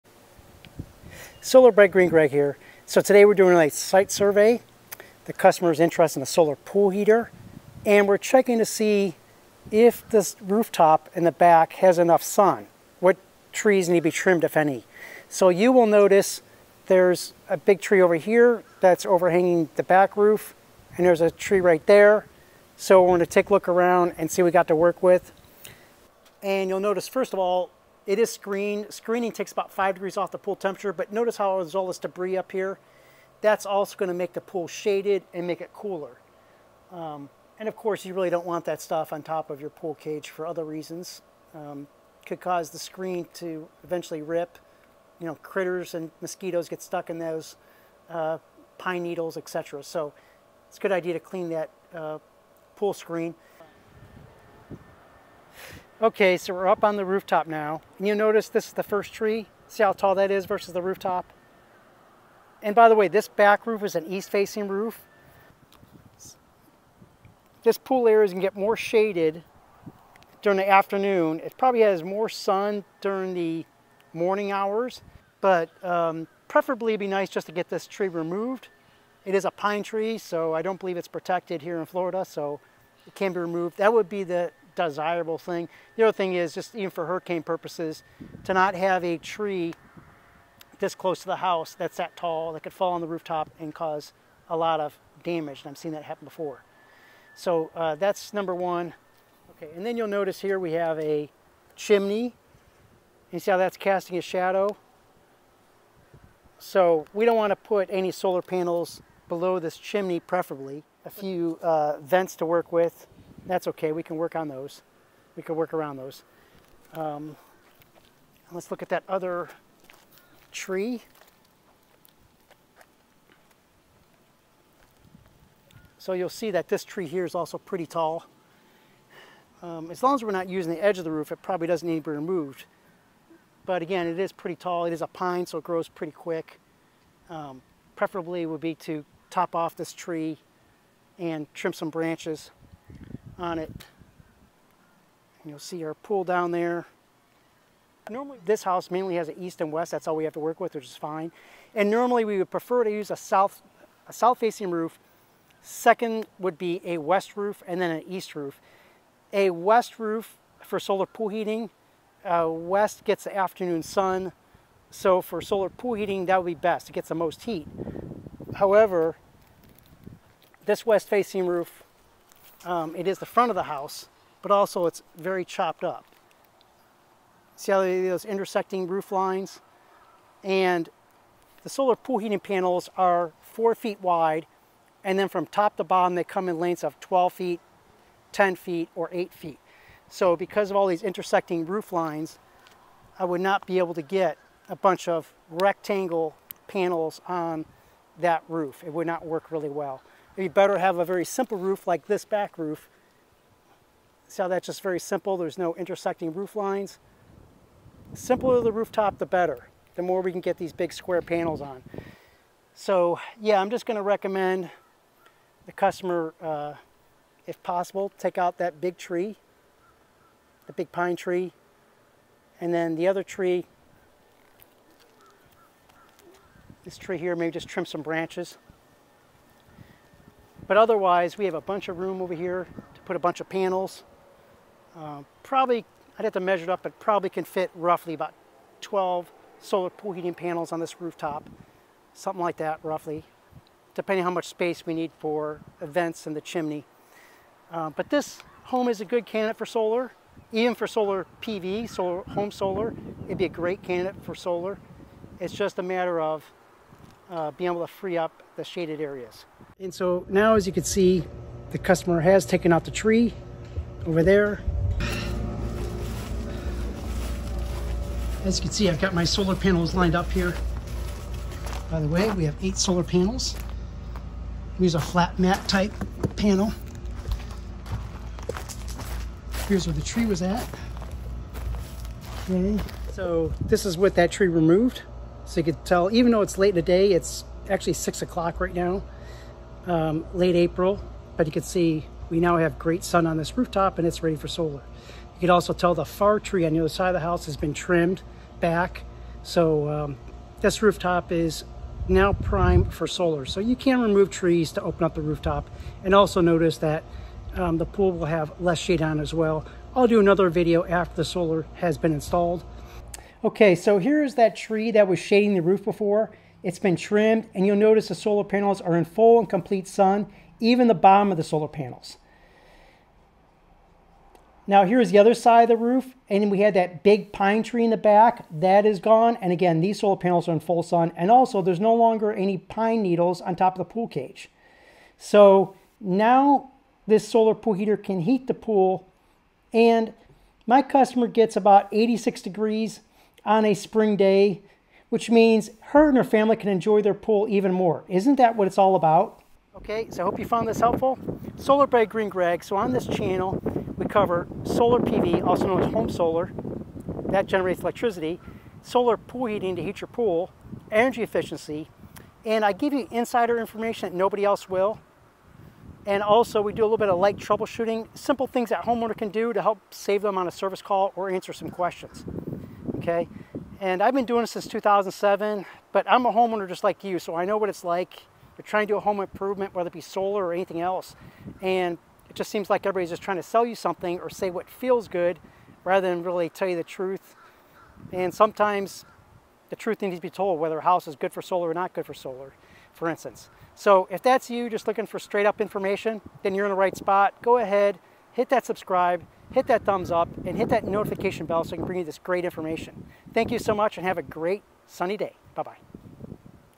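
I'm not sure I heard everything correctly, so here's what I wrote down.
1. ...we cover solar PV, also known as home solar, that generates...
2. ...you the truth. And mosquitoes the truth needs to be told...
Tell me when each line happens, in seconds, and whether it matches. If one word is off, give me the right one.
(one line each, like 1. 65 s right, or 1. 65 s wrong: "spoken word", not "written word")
1. 353 s right
2. 386 s wrong: "sometimes", not "mosquitoes".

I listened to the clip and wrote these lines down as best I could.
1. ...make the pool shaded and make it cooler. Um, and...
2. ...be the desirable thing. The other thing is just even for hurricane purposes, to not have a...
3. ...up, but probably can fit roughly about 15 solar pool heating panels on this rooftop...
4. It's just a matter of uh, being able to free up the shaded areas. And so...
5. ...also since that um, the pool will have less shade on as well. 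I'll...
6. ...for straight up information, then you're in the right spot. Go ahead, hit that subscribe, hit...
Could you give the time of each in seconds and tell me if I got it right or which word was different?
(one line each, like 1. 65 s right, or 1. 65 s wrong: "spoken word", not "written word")
1. 34 s right
2. 84 s right
3. 236 s wrong: "12", not "15"
4. 255 s right
5. 306 s wrong: "notice", not "since"
6. 395 s right.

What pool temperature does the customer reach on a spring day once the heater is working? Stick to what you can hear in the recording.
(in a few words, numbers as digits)
86 degrees.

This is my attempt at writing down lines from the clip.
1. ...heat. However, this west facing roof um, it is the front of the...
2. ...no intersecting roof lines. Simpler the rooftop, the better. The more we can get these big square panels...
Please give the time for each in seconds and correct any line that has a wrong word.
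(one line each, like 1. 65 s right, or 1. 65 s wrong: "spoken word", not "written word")
1. 167 s right
2. 205 s right.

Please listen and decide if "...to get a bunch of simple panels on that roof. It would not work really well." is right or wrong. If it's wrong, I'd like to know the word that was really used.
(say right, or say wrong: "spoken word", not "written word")
wrong: "rectangle", not "simple".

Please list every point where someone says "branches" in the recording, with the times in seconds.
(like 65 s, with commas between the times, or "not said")
141 s, 228 s.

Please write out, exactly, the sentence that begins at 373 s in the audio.
And I've been doing it since 2007, but I'm a homeowner just like you, so I know what it's like.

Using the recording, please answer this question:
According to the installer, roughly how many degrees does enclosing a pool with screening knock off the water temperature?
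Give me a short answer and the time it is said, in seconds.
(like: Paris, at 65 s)
5 degrees, at 29 s.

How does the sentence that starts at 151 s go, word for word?
And normally we would prefer to use a south, a south facing roof.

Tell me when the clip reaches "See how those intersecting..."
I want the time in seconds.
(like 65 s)
177 s.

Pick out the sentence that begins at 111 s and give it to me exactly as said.
A few uh, vents to work with that's okay.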